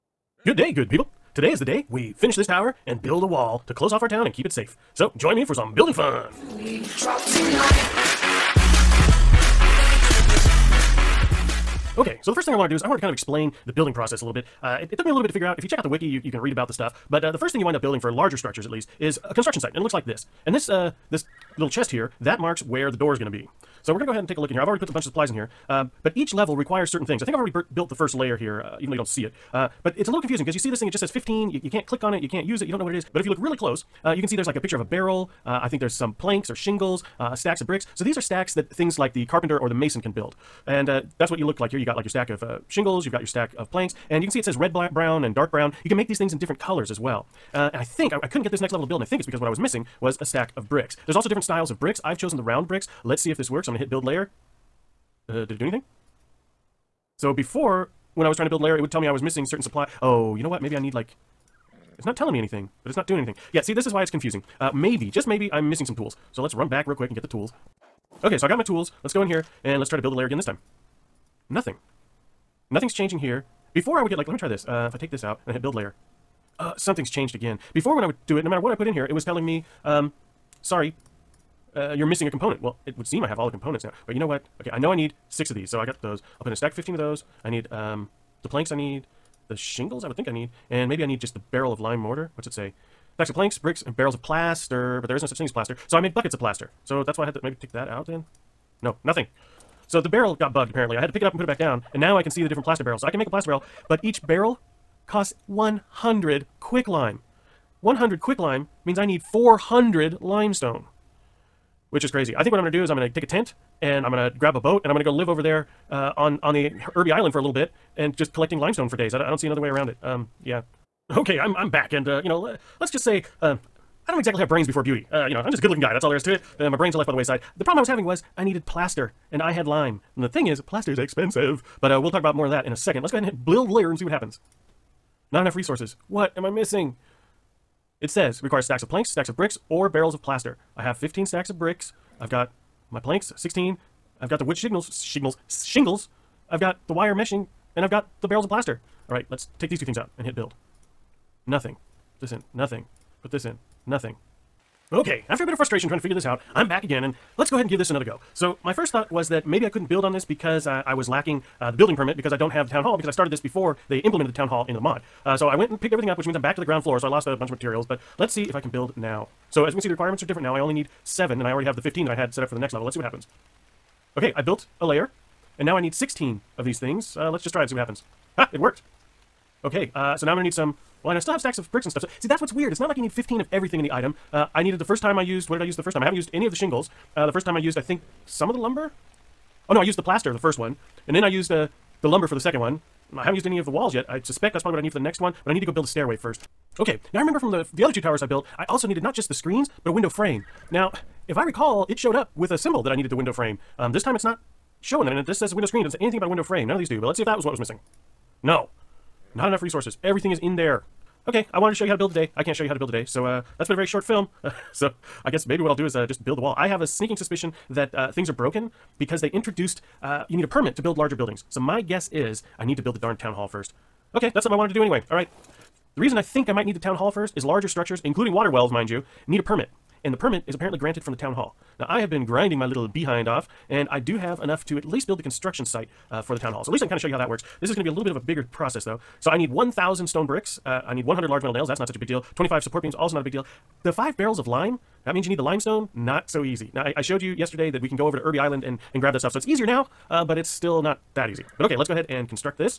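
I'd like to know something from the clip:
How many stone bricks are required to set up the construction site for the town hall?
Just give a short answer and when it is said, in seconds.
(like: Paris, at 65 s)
1,000, at 239 s.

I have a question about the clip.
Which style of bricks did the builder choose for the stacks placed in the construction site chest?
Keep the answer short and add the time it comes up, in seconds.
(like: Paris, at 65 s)
Round bricks, at 52 s.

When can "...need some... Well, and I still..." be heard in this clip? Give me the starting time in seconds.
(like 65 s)
180 s.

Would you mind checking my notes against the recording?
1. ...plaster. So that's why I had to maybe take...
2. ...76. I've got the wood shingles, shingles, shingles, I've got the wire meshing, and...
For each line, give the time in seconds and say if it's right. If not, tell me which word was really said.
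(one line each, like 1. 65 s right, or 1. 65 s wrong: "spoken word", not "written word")
1. 96 s right
2. 143 s wrong: "16", not "76".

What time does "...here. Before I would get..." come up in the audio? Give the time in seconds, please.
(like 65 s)
73 s.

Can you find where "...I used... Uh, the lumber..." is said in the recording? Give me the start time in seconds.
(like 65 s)
191 s.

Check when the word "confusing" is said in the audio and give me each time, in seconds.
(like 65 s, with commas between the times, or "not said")
30 s, 64 s.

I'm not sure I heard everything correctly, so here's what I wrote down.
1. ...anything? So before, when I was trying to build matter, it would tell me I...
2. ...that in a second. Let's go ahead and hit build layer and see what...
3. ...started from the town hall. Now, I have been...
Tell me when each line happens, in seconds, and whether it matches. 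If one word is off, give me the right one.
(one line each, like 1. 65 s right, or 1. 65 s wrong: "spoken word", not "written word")
1. 55 s wrong: "layer", not "matter"
2. 132 s right
3. 230 s wrong: "granted", not "started".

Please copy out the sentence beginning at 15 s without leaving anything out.
If you check out the wiki, you, you can read about the stuff.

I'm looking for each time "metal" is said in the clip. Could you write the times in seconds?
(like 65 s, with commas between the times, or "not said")
241 s.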